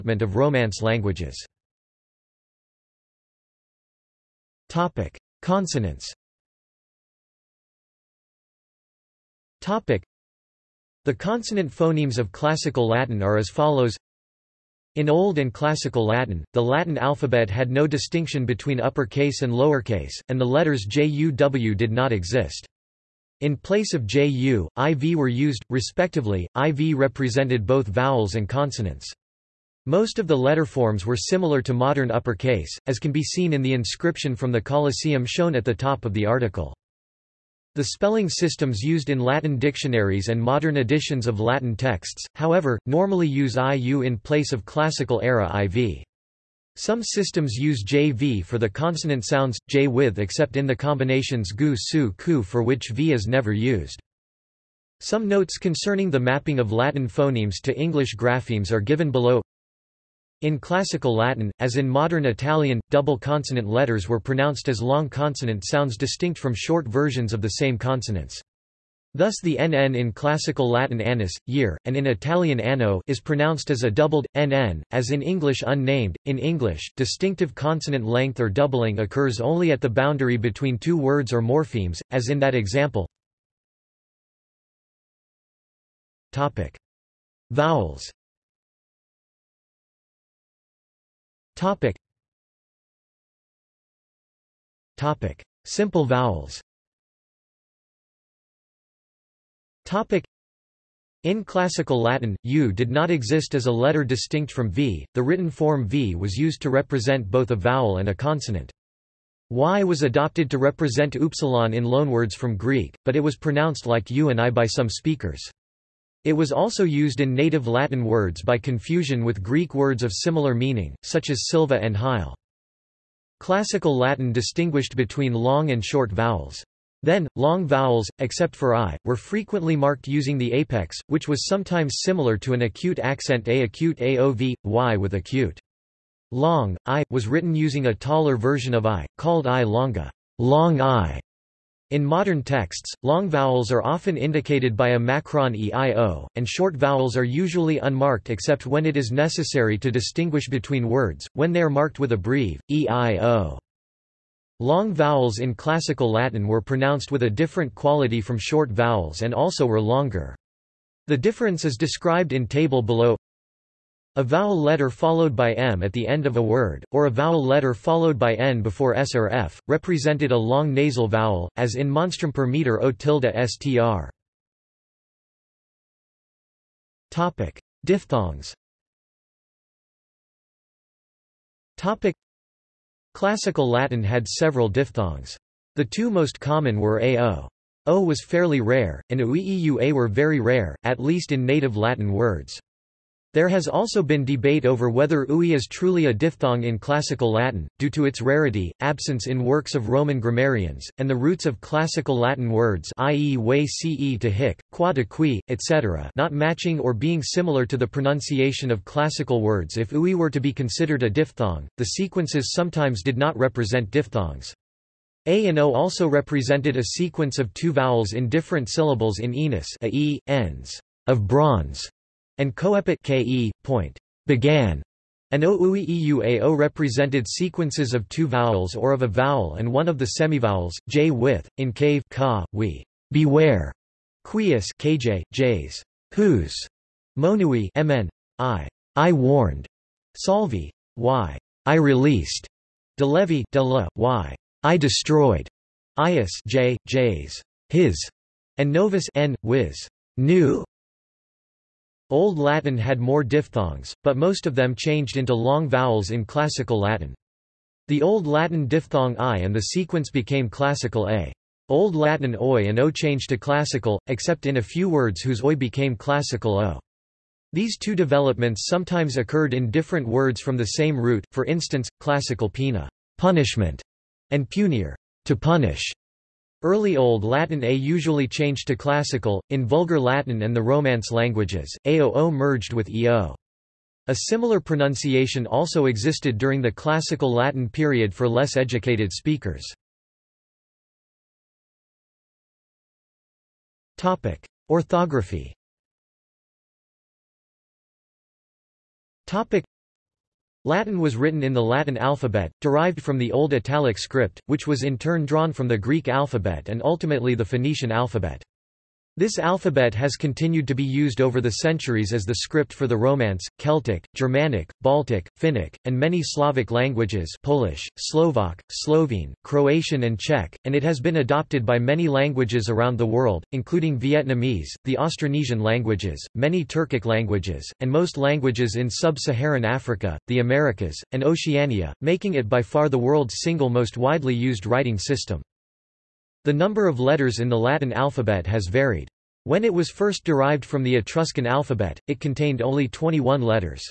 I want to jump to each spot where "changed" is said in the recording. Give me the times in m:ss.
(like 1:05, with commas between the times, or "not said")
4:14, 4:22, 4:38.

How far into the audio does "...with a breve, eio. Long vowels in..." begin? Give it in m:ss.
2:31.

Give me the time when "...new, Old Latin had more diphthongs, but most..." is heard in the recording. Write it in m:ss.
4:10.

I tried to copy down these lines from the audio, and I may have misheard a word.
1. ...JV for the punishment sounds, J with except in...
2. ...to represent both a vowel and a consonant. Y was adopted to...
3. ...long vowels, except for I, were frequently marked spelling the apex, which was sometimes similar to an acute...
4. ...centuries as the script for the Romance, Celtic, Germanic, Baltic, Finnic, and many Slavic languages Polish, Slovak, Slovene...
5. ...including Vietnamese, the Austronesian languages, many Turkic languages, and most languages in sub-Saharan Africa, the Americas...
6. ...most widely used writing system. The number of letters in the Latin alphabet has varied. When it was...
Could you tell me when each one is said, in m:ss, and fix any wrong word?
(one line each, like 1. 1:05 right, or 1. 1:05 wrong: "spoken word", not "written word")
1. 0:47 wrong: "consonant", not "punishment"
2. 1:46 right
3. 2:07 wrong: "using", not "spelling"
4. 5:11 right
5. 5:23 right
6. 5:33 right.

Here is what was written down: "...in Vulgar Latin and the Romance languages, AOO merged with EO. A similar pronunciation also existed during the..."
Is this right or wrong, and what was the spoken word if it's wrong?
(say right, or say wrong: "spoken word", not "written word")
right.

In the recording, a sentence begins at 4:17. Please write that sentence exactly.
The Old Latin diphthong I and the sequence became Classical A.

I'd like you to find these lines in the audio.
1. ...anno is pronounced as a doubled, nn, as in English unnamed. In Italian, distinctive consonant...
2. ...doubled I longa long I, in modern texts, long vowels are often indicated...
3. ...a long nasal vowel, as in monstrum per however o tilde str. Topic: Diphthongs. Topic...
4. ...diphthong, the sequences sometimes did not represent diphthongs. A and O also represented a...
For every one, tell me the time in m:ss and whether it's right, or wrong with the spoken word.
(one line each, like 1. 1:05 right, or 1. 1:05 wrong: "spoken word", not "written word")
1. 1:12 wrong: "English", not "Italian"
2. 2:19 wrong: "called", not "doubled"
3. 2:50 wrong: "meter", not "however"
4. 3:31 right.